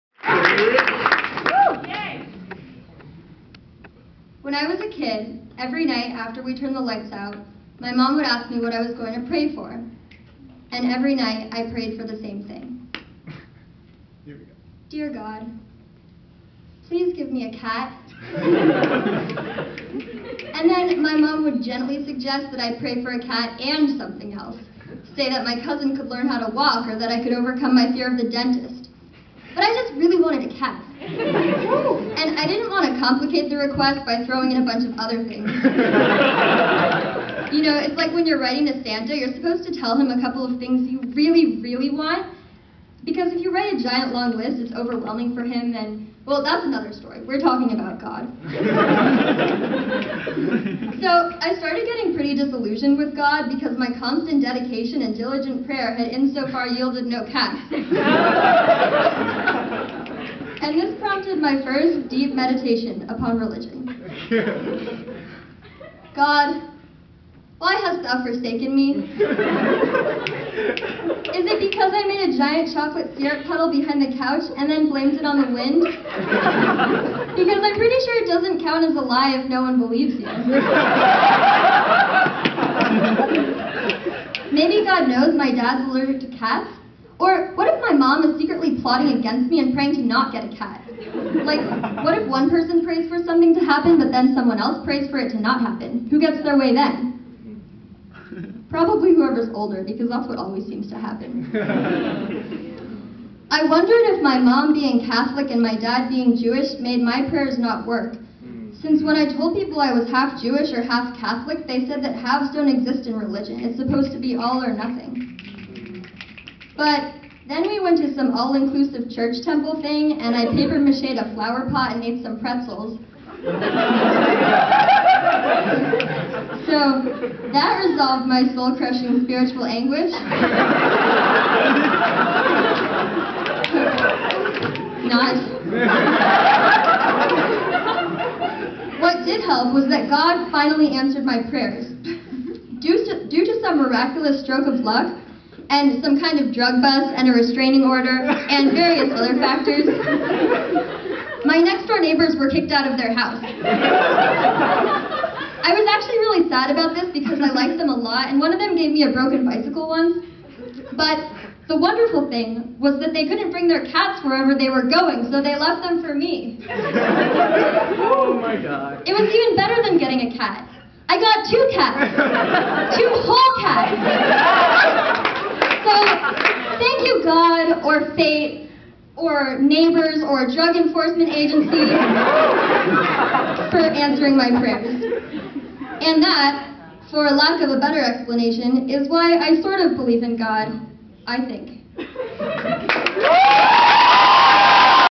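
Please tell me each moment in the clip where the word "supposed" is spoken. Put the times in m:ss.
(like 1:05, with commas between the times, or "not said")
0:39, 1:53.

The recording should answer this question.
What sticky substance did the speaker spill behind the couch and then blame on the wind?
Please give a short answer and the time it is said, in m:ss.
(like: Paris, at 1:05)
Chocolate syrup, at 1:12.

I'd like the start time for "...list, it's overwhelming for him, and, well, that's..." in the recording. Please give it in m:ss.
0:44.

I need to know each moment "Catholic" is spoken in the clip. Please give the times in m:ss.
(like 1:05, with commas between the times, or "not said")
1:45, 1:51.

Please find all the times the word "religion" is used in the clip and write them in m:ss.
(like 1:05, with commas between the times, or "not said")
1:03, 1:53.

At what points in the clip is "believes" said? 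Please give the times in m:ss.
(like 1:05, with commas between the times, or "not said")
1:19, 3:09.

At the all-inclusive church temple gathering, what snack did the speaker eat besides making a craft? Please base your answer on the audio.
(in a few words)
Pretzels.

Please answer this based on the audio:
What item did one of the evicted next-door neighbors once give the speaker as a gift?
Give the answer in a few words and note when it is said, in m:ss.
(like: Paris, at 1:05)
A broken bicycle, at 2:39.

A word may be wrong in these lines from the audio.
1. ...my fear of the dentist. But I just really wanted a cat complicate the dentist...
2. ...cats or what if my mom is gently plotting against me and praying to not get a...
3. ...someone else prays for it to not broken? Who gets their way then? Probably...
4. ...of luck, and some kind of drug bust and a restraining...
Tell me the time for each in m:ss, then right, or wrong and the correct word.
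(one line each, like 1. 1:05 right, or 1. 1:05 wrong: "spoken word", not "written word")
1. 0:27 wrong: "request", not "dentist"
2. 1:26 wrong: "secretly", not "gently"
3. 1:34 wrong: "happen", not "broken"
4. 2:24 right.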